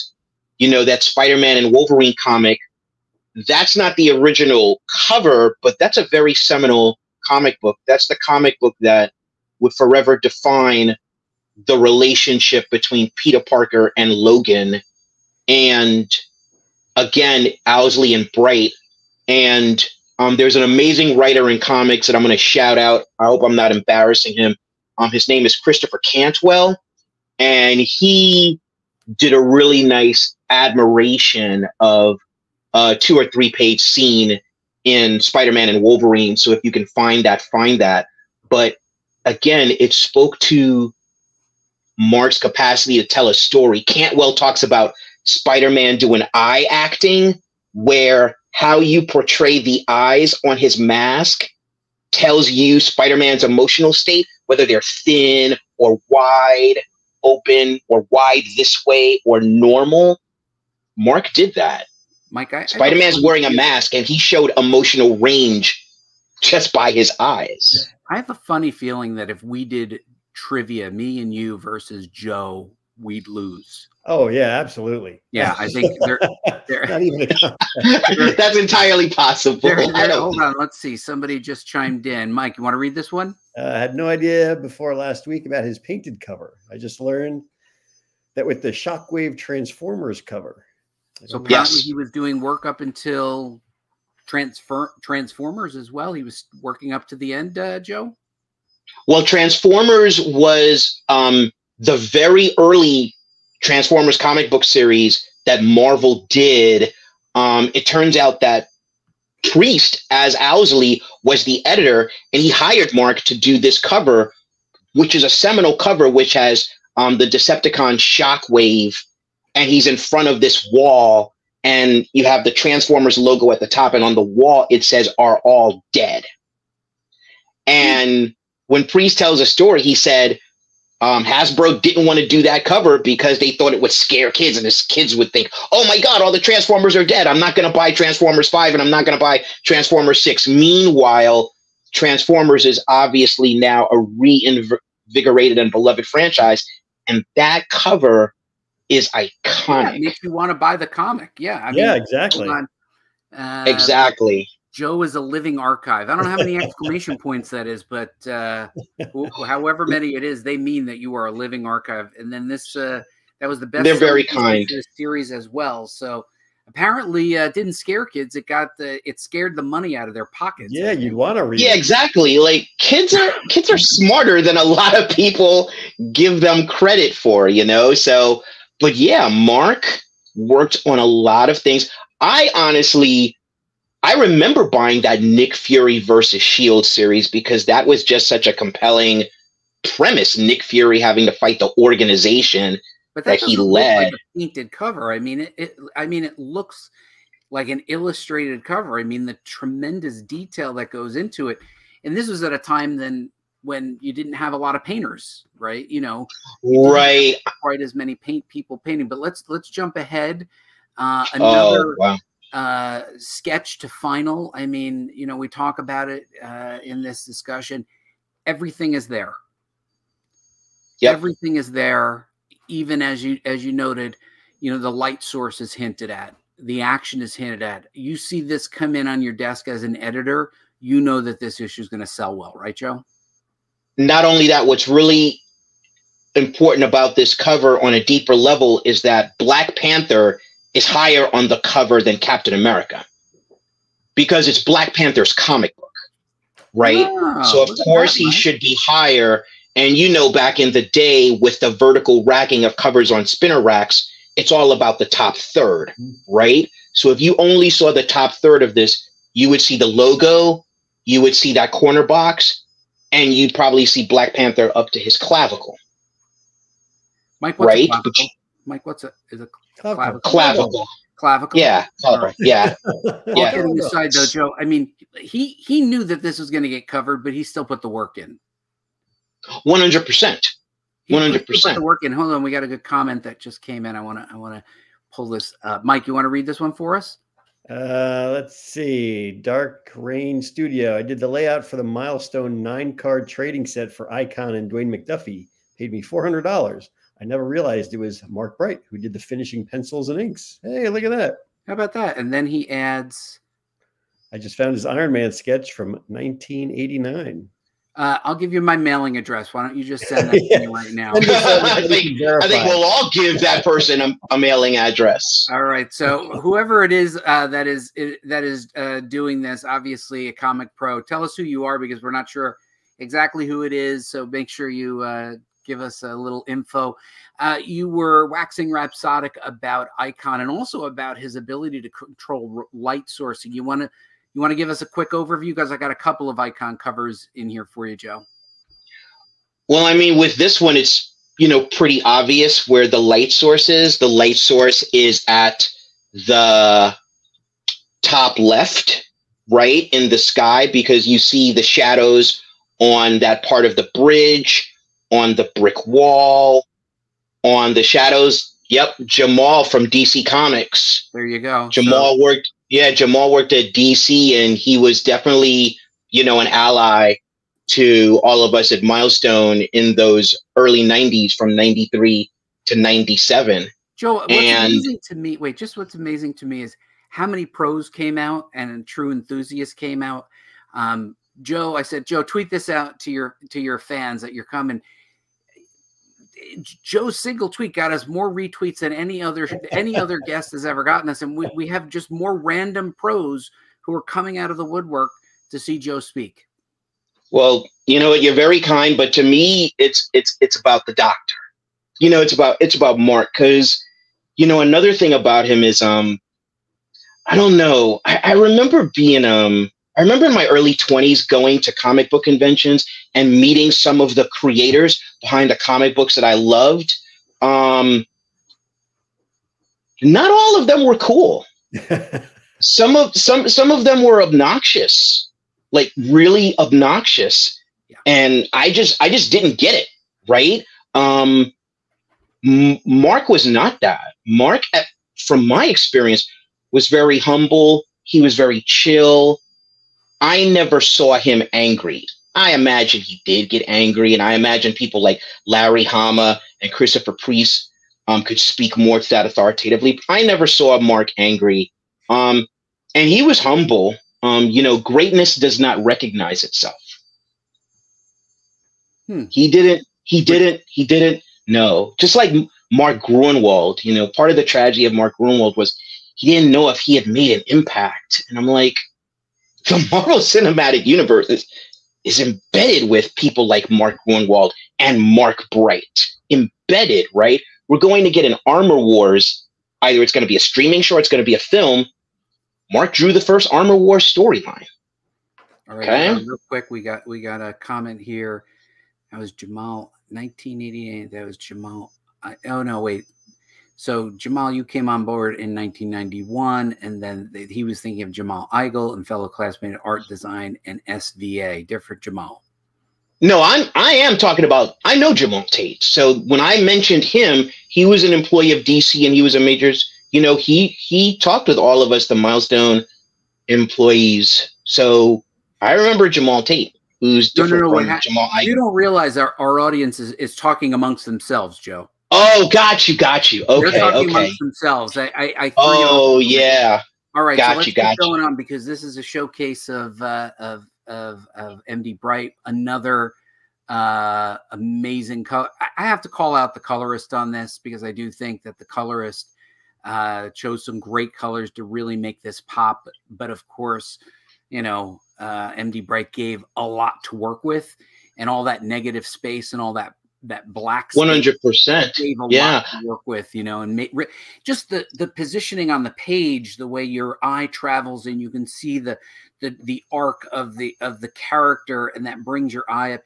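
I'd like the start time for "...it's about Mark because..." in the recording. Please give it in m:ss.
6:42.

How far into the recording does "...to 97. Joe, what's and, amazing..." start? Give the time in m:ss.
6:12.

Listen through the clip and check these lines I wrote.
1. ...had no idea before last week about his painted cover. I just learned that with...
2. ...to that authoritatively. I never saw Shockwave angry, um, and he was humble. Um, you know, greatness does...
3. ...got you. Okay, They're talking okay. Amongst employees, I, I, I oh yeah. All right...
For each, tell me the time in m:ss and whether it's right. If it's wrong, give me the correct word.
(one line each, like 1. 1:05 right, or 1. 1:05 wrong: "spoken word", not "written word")
1. 1:23 right
2. 7:28 wrong: "Mark", not "Shockwave"
3. 8:42 wrong: "themselves", not "employees".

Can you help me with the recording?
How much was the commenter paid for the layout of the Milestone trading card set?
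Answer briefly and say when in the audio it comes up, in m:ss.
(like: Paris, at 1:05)
$400, at 4:55.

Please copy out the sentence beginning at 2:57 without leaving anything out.
You know, so but yeah, Mark worked on a lot of things.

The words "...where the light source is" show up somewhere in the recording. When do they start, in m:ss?
5:42.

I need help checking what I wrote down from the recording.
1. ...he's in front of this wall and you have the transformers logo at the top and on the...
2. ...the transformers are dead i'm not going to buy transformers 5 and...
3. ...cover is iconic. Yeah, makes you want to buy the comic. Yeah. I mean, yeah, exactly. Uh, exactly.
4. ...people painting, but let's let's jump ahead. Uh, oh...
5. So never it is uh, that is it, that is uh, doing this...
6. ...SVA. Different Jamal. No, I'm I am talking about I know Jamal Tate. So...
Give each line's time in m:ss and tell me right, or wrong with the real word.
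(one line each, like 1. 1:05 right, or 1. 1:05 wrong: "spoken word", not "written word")
1. 1:59 right
2. 2:16 right
3. 2:27 right
4. 3:28 right
5. 5:15 wrong: "whoever", not "never"
6. 8:20 right.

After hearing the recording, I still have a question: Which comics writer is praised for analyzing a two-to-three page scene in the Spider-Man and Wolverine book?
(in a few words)
Christopher Cantwell.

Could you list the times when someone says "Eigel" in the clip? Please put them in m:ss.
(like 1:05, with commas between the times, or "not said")
8:18, 8:38.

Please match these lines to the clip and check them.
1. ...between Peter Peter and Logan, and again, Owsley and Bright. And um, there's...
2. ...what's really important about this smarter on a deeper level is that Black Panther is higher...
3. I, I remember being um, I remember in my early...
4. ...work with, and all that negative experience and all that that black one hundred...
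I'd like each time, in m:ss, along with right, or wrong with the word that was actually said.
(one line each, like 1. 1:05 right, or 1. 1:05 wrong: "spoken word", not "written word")
1. 0:12 wrong: "Parker", not "Peter"
2. 3:54 wrong: "cover", not "smarter"
3. 6:48 right
4. 9:07 wrong: "space", not "experience".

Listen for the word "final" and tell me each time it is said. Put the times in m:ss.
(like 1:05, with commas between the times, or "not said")
3:33.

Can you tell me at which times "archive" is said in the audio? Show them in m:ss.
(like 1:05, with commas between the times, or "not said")
2:35, 2:41.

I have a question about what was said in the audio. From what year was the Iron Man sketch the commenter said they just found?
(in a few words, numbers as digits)
1989.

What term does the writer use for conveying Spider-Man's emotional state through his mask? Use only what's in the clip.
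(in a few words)
eye acting.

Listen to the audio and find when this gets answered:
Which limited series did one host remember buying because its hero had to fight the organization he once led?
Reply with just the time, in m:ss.
3:05.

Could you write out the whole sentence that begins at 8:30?
You know, he he talked with all of us, the milestone employees.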